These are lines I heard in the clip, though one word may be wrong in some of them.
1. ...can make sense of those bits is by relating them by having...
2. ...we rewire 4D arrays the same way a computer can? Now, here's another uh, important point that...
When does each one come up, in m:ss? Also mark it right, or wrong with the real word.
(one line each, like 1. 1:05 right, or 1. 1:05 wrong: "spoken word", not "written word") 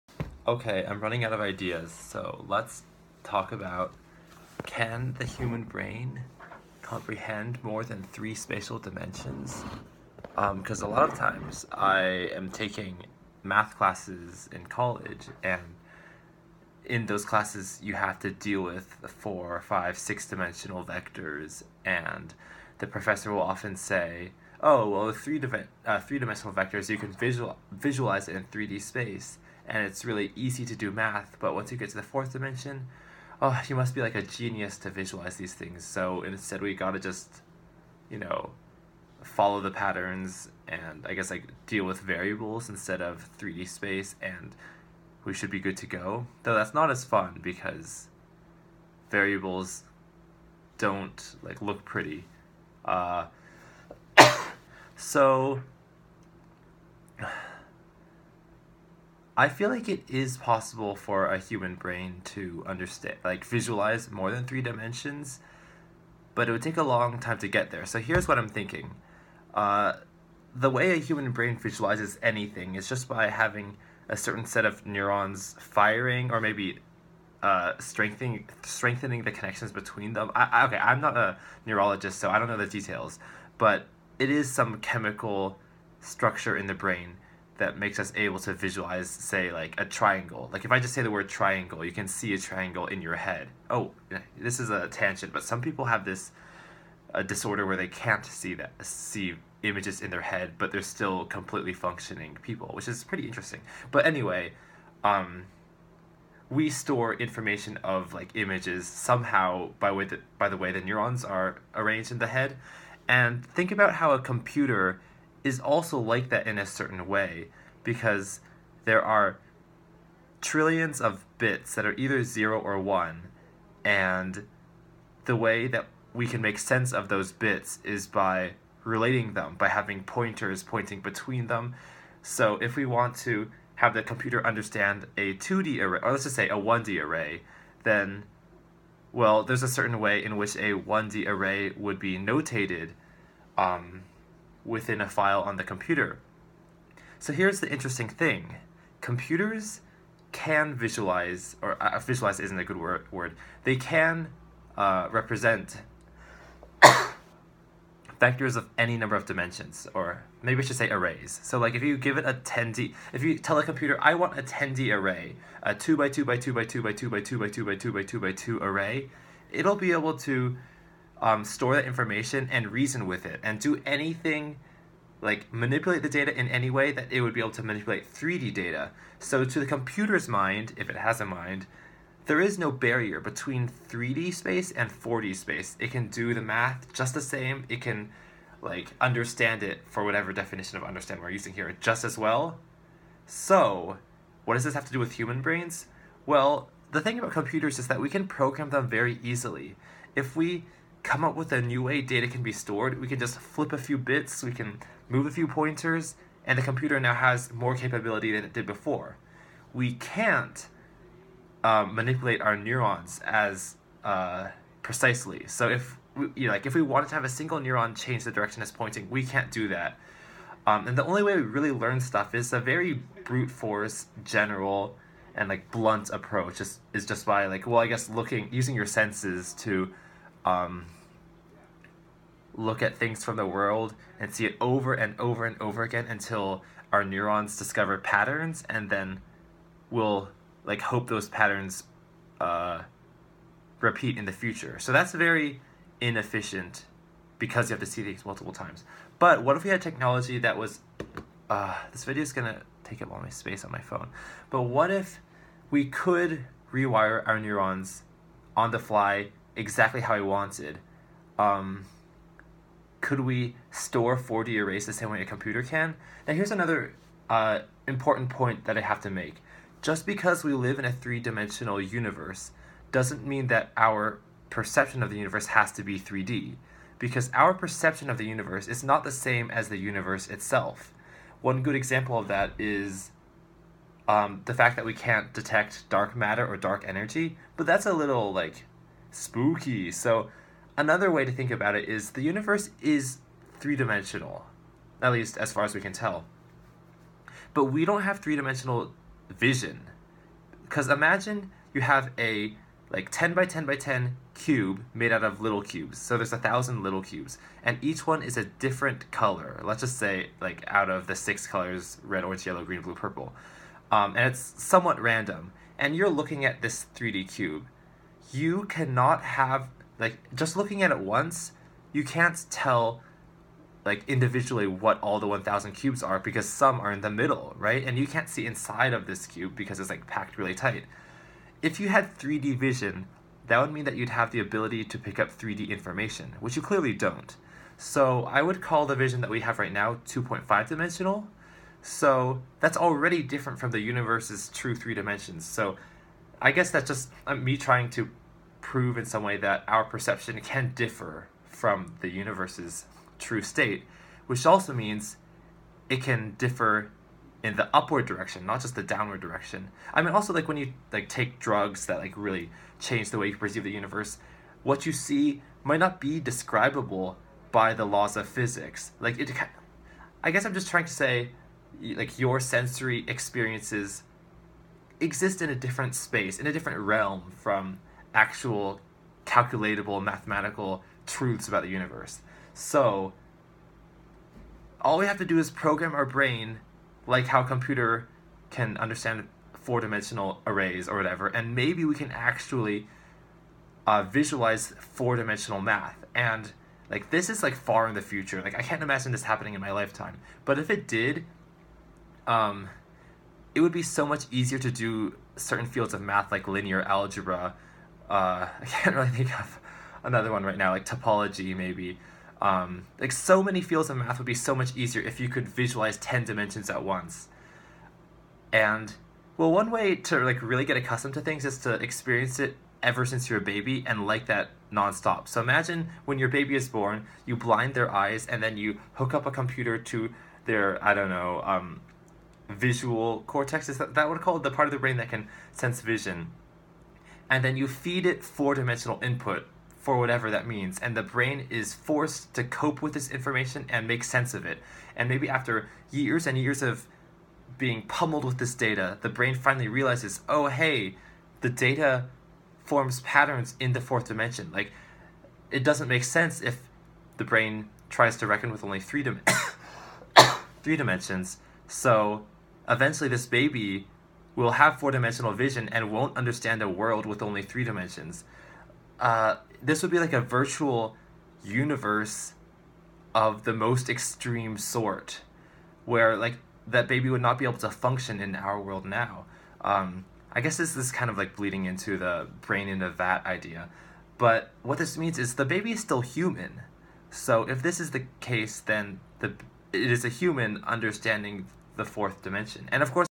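1. 2:06 right
2. 4:23 wrong: "store", not "rewire".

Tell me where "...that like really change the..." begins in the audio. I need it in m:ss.
6:01.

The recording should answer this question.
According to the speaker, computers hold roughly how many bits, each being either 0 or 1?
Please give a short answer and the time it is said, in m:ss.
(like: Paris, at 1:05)
trillions, at 2:00.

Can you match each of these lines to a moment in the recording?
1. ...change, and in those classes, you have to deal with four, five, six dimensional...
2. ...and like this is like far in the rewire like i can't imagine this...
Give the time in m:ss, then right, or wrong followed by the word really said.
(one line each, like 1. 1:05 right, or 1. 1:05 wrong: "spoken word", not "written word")
1. 0:14 wrong: "college", not "change"
2. 6:36 wrong: "future", not "rewire".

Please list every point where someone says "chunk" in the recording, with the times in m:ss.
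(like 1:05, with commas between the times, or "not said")
not said.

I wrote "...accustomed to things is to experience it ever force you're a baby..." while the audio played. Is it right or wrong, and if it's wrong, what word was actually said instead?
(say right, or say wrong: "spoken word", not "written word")
wrong: "since", not "force".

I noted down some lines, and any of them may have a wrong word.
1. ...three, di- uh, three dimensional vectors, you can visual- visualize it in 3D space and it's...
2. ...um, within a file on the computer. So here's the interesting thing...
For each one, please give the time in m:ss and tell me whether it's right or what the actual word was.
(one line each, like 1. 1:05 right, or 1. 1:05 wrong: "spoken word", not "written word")
1. 0:25 right
2. 2:23 right.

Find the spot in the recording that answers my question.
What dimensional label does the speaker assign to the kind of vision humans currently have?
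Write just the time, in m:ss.
5:40.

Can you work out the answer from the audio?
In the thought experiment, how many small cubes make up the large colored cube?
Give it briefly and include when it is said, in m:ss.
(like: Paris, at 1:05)
1000, at 5:06.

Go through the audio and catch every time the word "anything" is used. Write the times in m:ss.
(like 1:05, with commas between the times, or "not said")
1:12, 2:53.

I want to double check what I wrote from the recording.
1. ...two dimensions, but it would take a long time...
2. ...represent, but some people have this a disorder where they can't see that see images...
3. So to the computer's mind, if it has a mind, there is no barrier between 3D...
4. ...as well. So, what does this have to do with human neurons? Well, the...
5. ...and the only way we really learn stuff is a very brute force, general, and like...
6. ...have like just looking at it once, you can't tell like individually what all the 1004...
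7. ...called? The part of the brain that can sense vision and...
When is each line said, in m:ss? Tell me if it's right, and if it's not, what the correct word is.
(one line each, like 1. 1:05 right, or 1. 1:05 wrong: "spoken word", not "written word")
1. 1:04 wrong: "three", not "two"
2. 1:34 wrong: "tangent", not "represent"
3. 2:59 right
4. 3:12 wrong: "brains", not "neurons"
5. 3:40 right
6. 5:19 wrong: "1000", not "1004"
7. 7:14 right.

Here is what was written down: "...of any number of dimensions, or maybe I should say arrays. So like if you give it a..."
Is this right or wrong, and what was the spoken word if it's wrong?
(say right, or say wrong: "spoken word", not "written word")
right.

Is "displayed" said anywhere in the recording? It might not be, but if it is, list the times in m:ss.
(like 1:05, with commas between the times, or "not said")
not said.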